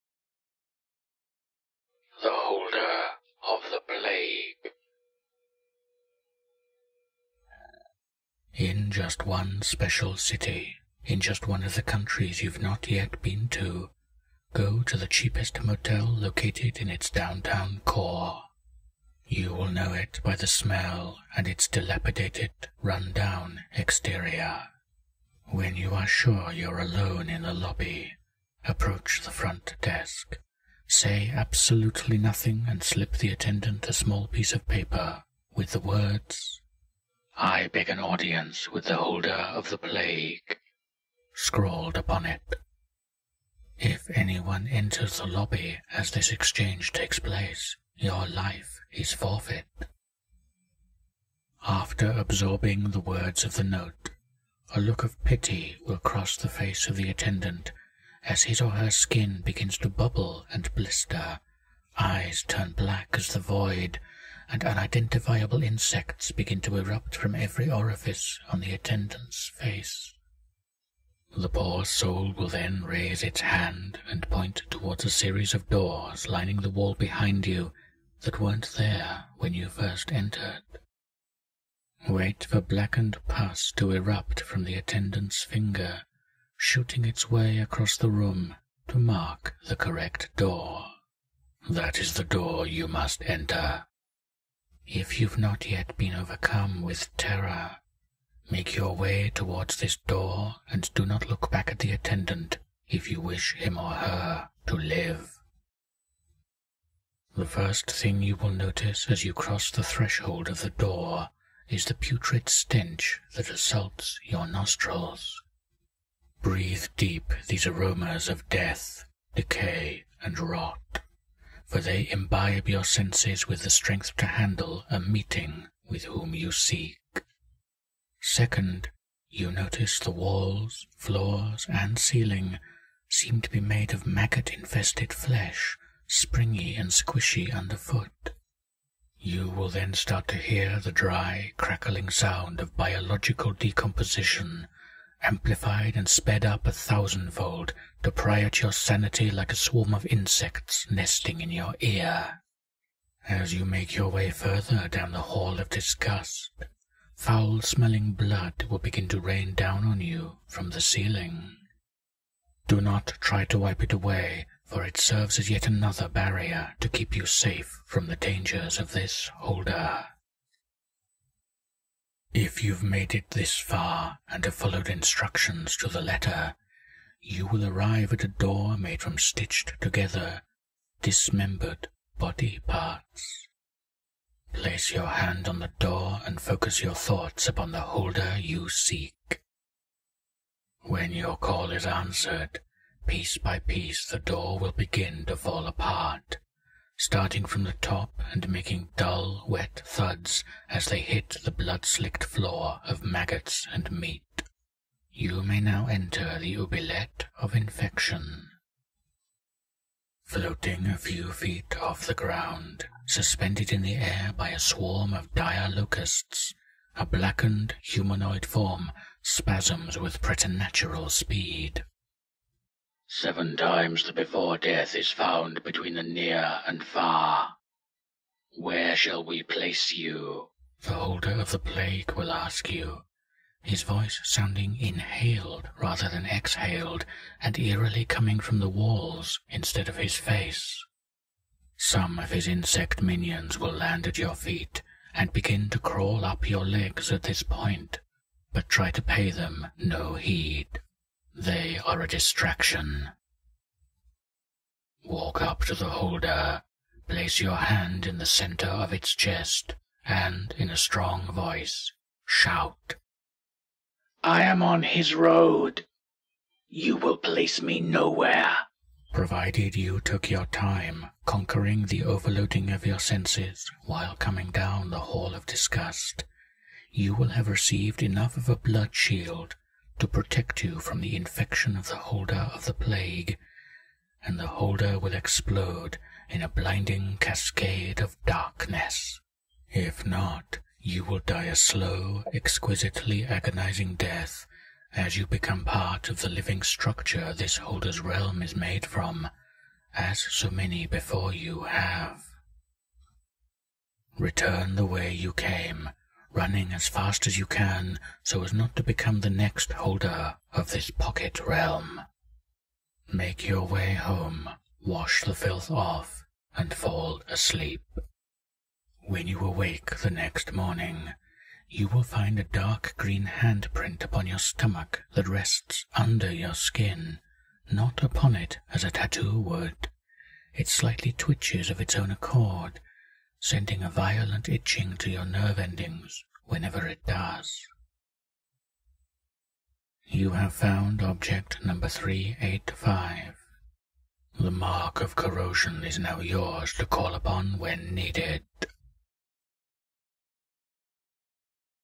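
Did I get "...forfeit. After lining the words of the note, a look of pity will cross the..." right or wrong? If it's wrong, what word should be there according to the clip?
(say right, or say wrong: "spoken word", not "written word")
wrong: "absorbing", not "lining".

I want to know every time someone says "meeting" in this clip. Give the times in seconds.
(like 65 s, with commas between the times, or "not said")
124 s.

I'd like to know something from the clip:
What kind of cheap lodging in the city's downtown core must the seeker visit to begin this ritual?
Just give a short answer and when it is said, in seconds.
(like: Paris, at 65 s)
Motel, at 15 s.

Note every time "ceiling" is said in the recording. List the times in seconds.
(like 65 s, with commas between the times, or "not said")
131 s, 160 s.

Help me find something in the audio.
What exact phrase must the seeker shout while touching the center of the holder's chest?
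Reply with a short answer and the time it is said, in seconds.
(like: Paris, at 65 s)
I am on his road, at 264 s.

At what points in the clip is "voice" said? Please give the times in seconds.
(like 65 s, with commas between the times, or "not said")
233 s, 261 s.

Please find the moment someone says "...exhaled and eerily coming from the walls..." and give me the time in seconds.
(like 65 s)
236 s.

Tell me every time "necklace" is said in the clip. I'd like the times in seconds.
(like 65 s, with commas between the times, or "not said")
not said.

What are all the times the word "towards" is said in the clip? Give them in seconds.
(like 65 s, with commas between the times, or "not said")
74 s, 99 s.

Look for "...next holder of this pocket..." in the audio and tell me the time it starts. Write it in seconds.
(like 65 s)
309 s.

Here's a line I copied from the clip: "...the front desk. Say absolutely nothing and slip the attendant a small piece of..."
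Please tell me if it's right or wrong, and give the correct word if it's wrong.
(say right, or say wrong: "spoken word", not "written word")
right.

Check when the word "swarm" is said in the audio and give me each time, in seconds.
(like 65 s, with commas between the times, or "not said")
149 s, 214 s.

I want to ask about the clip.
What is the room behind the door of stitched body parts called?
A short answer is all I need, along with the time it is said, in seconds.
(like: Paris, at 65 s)
Oubliette of infection, at 206 s.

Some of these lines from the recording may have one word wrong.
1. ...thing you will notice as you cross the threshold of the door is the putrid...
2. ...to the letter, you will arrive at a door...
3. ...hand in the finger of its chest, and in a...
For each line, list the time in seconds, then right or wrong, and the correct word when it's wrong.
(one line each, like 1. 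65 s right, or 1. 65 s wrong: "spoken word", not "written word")
1. 107 s right
2. 175 s right
3. 257 s wrong: "center", not "finger".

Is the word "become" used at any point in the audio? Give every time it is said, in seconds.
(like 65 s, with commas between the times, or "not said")
295 s, 308 s.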